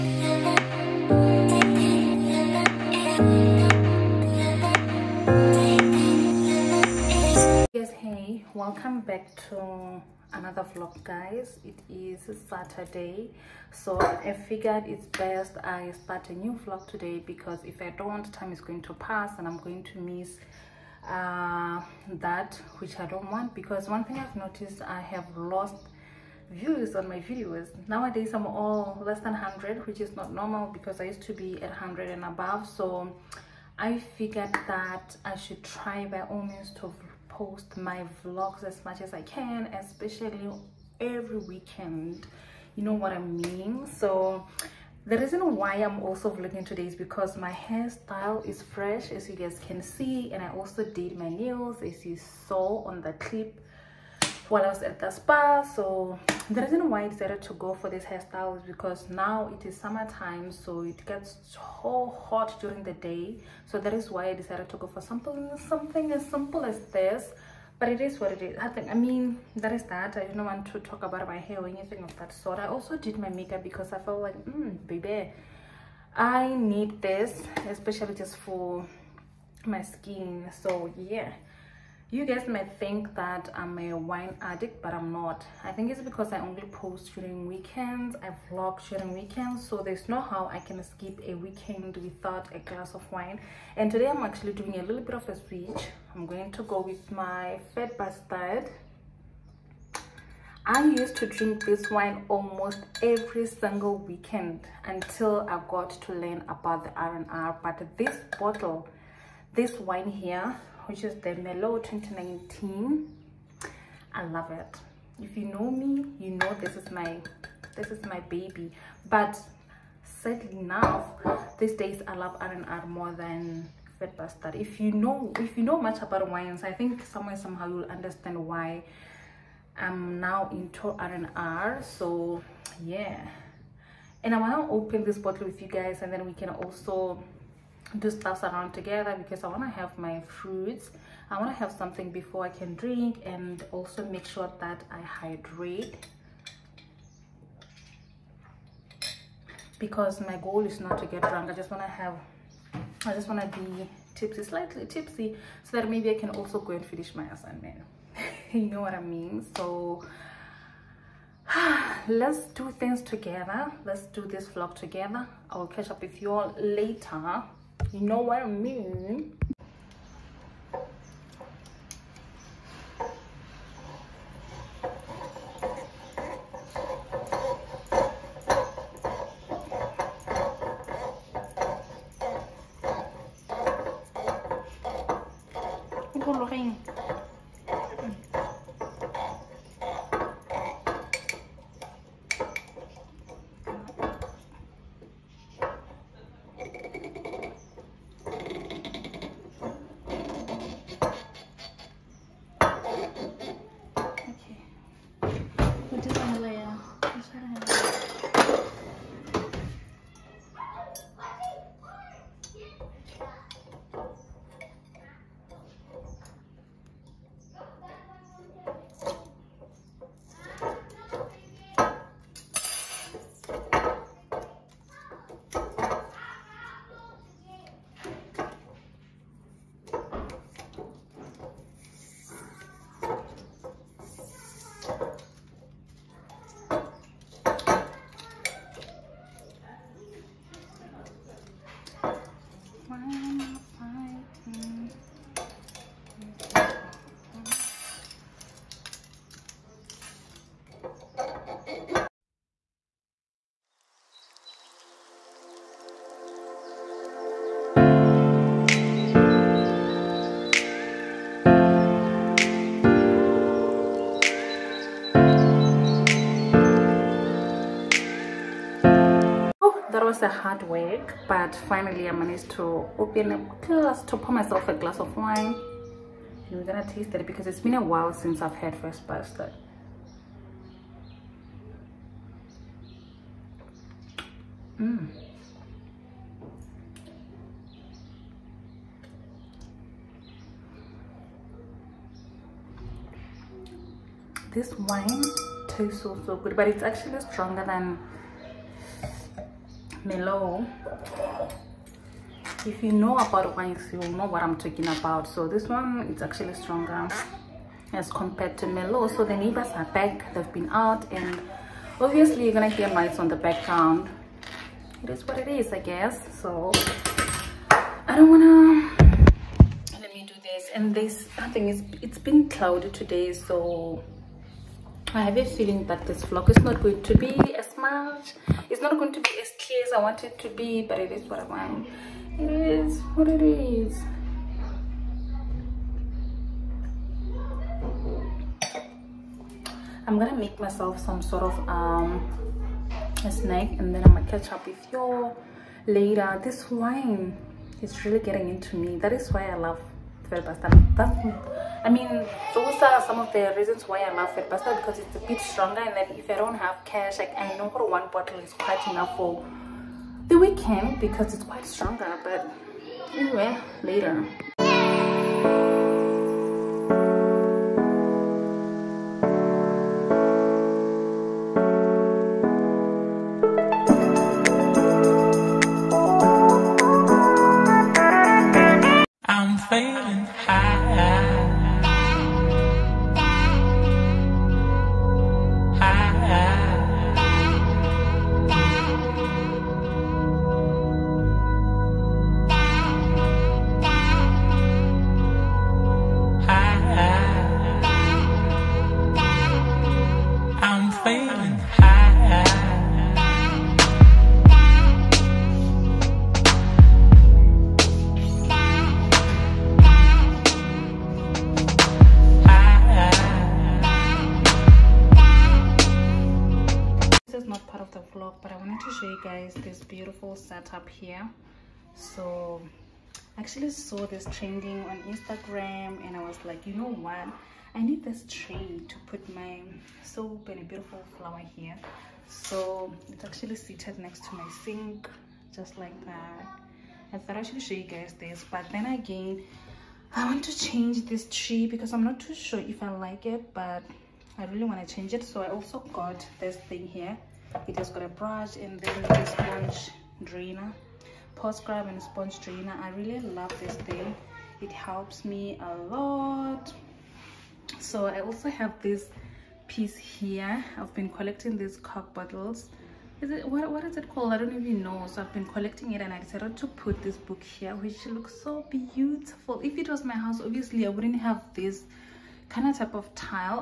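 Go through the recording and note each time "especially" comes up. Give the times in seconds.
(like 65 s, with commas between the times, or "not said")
39 s, 77 s.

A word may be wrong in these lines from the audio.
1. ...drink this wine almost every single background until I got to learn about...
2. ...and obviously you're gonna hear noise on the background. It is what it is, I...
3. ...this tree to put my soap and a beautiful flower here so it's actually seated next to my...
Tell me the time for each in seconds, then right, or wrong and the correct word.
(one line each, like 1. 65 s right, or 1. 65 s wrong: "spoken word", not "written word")
1. 101 s wrong: "weekend", not "background"
2. 311 s right
3. 428 s right.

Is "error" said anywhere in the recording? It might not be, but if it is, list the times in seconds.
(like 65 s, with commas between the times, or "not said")
not said.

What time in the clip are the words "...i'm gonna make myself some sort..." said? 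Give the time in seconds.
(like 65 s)
340 s.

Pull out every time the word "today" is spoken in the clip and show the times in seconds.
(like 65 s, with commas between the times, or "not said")
16 s, 46 s, 93 s, 322 s.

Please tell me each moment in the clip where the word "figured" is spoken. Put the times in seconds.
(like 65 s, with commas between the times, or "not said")
14 s, 34 s.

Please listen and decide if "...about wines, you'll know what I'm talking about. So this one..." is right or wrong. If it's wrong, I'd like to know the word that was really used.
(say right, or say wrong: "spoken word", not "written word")
right.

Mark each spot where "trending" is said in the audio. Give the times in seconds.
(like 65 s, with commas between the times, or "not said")
424 s.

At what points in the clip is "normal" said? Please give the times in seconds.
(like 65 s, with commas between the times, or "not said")
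30 s.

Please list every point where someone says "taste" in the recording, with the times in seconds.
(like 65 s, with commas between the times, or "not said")
276 s, 295 s.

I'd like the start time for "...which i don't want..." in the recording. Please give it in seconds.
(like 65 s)
22 s.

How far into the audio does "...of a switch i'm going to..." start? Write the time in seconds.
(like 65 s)
95 s.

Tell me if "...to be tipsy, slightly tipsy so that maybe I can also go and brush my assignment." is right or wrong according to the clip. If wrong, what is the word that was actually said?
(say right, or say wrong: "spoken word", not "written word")
wrong: "finish", not "brush".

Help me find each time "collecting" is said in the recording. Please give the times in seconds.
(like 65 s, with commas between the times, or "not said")
461 s, 465 s.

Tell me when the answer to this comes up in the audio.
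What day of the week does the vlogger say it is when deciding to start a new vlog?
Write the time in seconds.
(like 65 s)
12 s.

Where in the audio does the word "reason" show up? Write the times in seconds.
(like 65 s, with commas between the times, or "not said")
45 s, 56 s, 353 s.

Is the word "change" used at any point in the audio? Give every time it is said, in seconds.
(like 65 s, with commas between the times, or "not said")
440 s, 444 s.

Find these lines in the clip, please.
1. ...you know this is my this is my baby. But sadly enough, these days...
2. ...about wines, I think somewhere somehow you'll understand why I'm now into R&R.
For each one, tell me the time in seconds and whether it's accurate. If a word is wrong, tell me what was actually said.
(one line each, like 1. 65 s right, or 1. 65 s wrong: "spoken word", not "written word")
1. 116 s right
2. 126 s right.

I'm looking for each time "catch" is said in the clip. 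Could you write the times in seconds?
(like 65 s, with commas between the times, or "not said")
165 s, 344 s.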